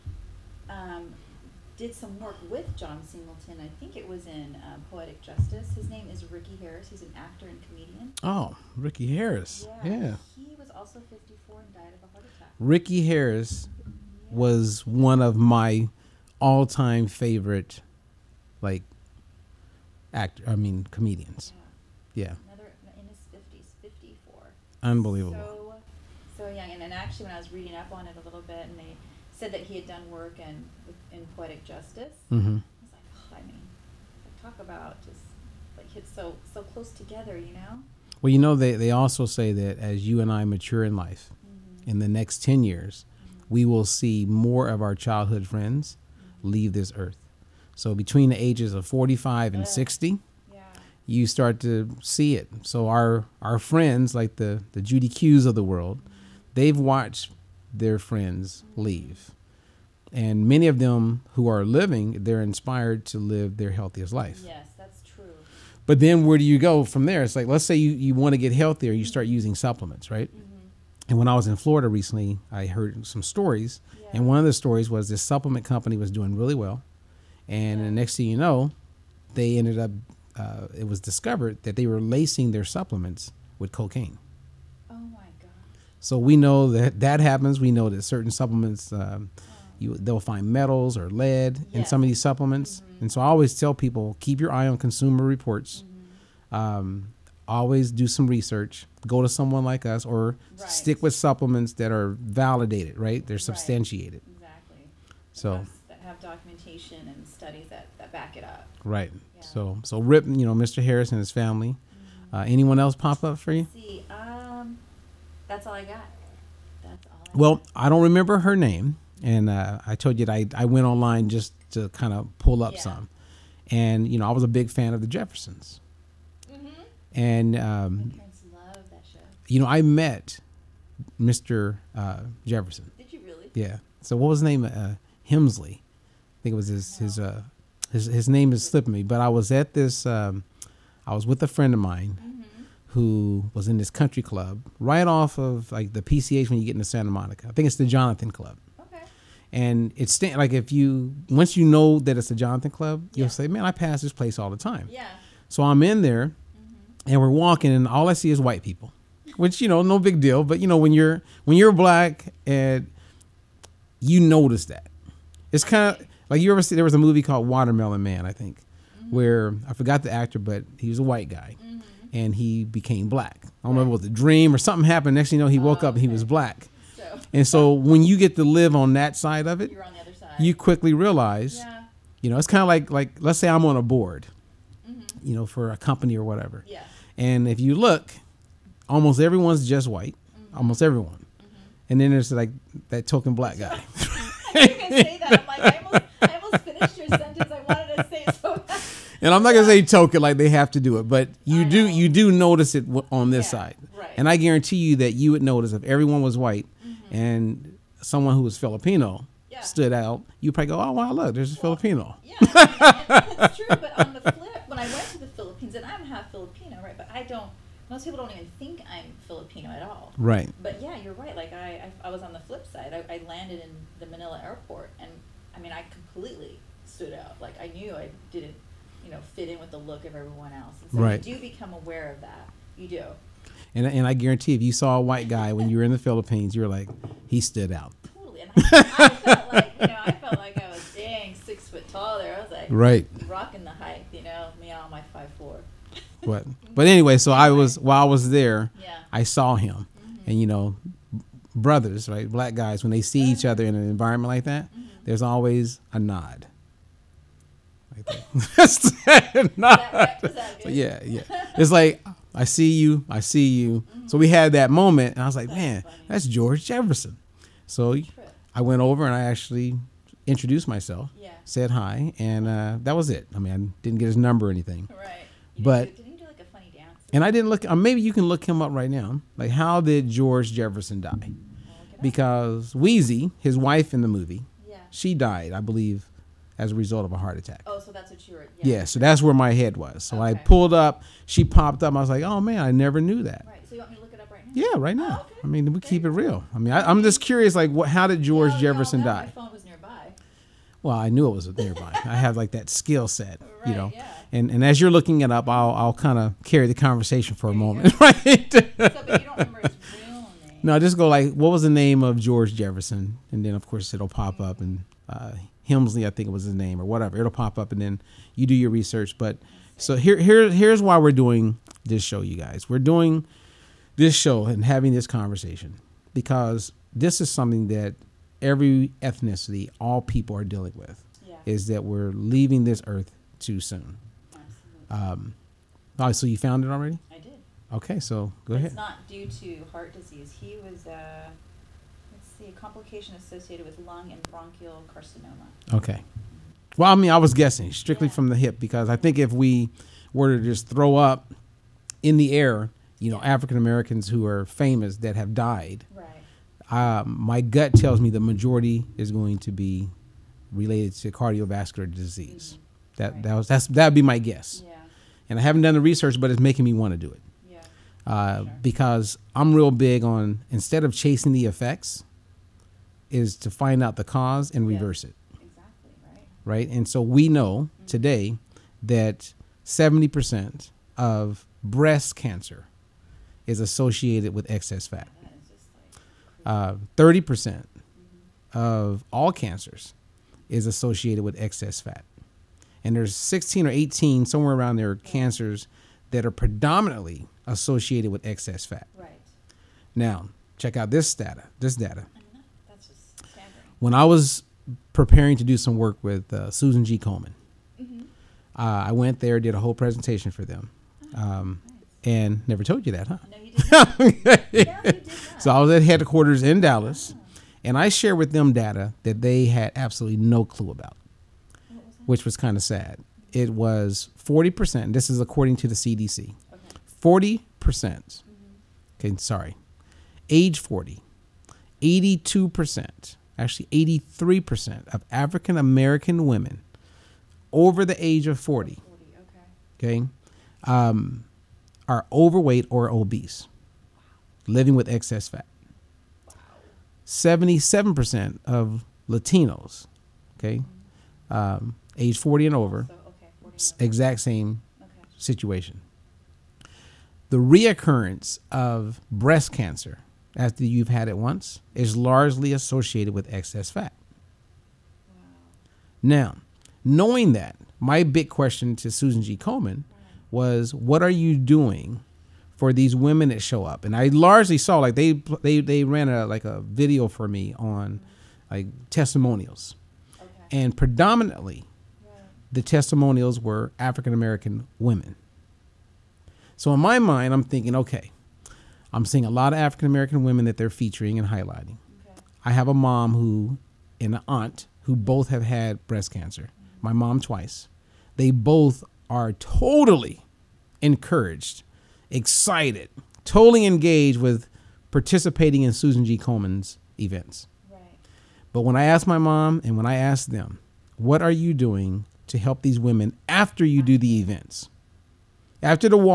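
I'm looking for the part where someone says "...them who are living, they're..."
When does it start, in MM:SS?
01:00.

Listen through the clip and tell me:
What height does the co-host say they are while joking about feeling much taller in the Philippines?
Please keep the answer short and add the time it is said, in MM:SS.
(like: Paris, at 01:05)
5'4", at 04:05.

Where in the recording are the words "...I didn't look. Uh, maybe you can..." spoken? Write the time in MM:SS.
04:37.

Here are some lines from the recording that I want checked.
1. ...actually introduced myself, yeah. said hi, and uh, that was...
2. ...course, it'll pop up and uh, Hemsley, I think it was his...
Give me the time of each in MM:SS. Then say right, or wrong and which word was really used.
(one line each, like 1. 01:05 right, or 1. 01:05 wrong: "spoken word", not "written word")
1. 04:29 right
2. 05:13 right.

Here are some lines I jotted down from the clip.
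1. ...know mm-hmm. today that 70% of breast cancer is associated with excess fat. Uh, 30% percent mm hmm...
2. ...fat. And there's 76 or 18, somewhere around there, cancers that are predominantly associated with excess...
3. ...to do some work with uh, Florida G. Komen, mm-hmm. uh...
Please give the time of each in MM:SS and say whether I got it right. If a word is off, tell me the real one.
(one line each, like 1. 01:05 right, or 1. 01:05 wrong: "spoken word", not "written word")
1. 06:17 right
2. 06:31 wrong: "16", not "76"
3. 06:45 wrong: "Susan", not "Florida".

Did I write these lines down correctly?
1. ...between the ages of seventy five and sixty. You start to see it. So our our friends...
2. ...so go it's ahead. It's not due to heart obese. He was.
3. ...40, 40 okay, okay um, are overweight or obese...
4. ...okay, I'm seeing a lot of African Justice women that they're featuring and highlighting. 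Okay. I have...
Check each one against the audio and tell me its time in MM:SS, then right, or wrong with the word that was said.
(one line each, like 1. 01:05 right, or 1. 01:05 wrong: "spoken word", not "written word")
1. 00:47 wrong: "forty", not "seventy"
2. 05:37 wrong: "disease", not "obese"
3. 07:18 right
4. 08:07 wrong: "American", not "Justice".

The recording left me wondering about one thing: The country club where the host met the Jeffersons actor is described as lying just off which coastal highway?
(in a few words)
PCH.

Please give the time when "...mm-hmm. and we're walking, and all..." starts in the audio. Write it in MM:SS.
02:36.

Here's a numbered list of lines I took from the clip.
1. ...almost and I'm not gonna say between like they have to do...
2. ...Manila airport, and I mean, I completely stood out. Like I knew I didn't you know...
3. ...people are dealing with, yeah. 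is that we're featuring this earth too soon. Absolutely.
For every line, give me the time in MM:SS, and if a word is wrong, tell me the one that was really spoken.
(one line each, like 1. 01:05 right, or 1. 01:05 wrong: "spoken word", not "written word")
1. 03:15 wrong: "token", not "between"
2. 03:44 right
3. 05:30 wrong: "leaving", not "featuring".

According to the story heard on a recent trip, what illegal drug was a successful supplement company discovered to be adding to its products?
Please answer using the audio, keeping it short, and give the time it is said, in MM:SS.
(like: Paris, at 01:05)
Cocaine, at 01:23.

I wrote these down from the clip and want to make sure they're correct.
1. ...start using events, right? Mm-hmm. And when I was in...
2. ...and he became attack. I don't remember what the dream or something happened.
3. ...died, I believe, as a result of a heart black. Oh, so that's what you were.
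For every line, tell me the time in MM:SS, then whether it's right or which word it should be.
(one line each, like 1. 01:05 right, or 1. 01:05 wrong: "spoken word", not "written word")
1. 01:09 wrong: "supplements", not "events"
2. 02:52 wrong: "black", not "attack"
3. 04:45 wrong: "attack", not "black".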